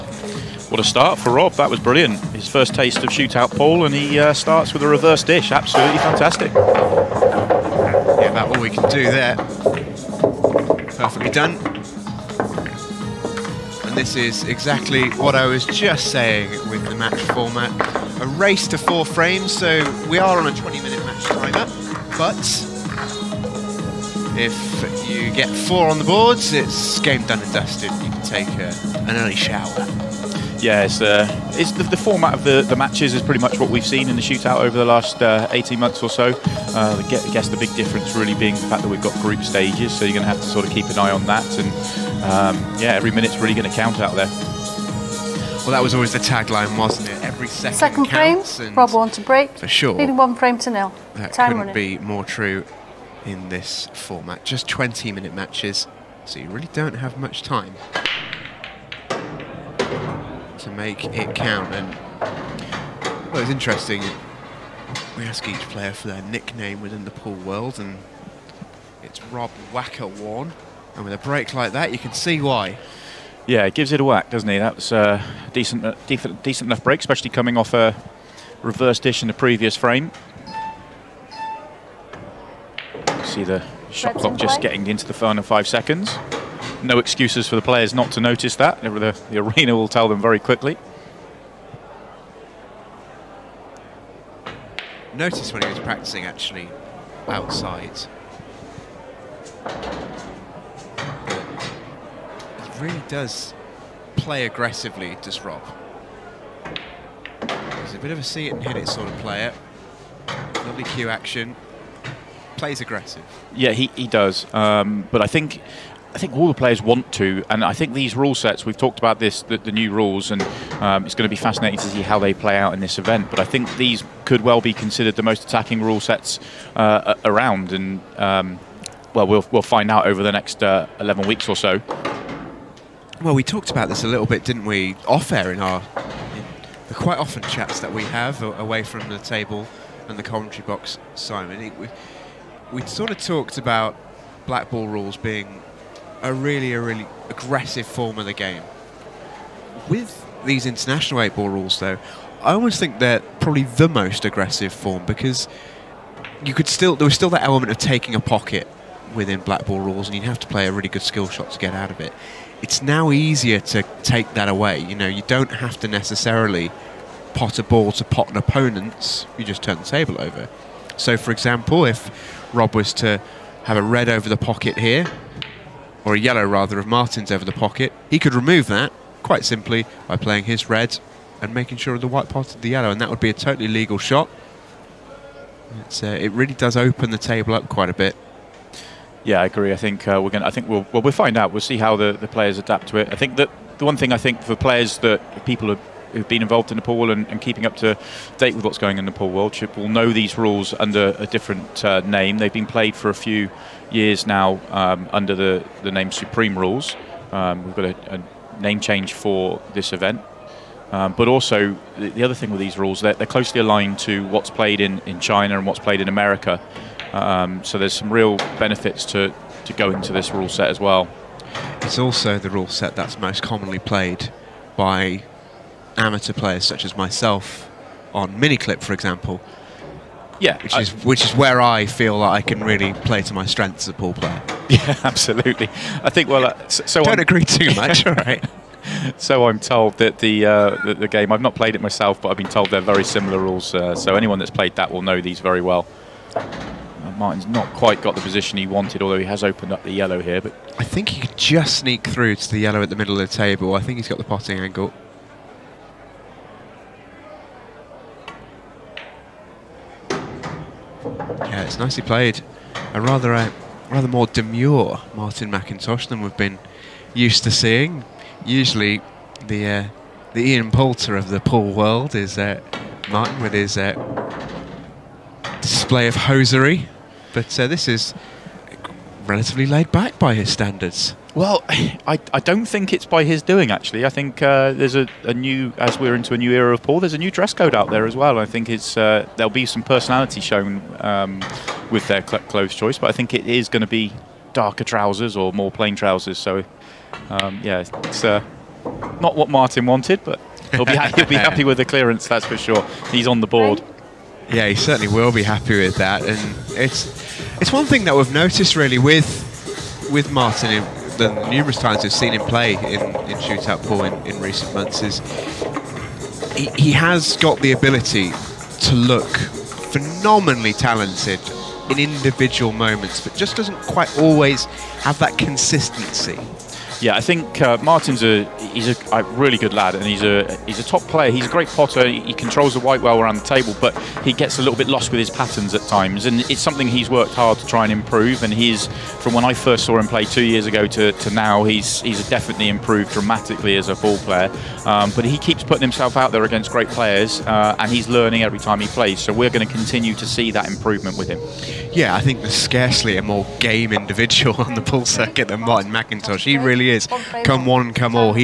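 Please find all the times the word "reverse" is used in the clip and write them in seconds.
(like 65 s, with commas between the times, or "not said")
4 s, 78 s.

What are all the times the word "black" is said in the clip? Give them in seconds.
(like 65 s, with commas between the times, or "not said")
144 s, 159 s.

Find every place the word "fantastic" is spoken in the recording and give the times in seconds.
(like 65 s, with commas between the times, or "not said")
5 s.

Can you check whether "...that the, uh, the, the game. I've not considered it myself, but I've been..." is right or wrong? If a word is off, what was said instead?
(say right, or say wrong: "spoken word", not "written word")
wrong: "played", not "considered".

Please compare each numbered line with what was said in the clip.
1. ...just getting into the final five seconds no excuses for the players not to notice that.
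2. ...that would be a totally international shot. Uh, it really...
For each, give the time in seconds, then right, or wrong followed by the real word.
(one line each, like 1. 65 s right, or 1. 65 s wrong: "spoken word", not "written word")
1. 84 s right
2. 183 s wrong: "legal", not "international".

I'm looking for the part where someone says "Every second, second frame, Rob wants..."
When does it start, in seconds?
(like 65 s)
47 s.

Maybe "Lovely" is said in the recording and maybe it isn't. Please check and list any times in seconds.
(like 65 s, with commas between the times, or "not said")
110 s.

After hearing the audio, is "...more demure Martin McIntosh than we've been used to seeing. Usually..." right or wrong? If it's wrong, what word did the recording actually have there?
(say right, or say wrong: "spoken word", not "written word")
right.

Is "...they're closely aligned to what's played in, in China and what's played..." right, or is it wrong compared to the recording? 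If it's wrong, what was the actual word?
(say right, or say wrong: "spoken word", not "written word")
right.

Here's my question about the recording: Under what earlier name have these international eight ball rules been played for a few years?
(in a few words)
Supreme Rules.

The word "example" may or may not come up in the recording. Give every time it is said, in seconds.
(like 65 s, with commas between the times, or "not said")
171 s, 228 s.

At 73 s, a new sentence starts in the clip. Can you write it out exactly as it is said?
Yeah, it gives it a whack, doesn't it?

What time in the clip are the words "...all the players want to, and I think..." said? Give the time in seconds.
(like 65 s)
116 s.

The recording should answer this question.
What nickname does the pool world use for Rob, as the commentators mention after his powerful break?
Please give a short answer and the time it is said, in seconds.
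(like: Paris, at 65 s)
Wacker, at 69 s.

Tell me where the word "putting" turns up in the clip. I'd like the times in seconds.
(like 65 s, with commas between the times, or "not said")
345 s.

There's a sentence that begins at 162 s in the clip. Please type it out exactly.
It's now easier to take that away.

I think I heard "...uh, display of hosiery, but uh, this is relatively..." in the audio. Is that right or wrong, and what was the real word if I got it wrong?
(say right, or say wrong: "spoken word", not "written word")
right.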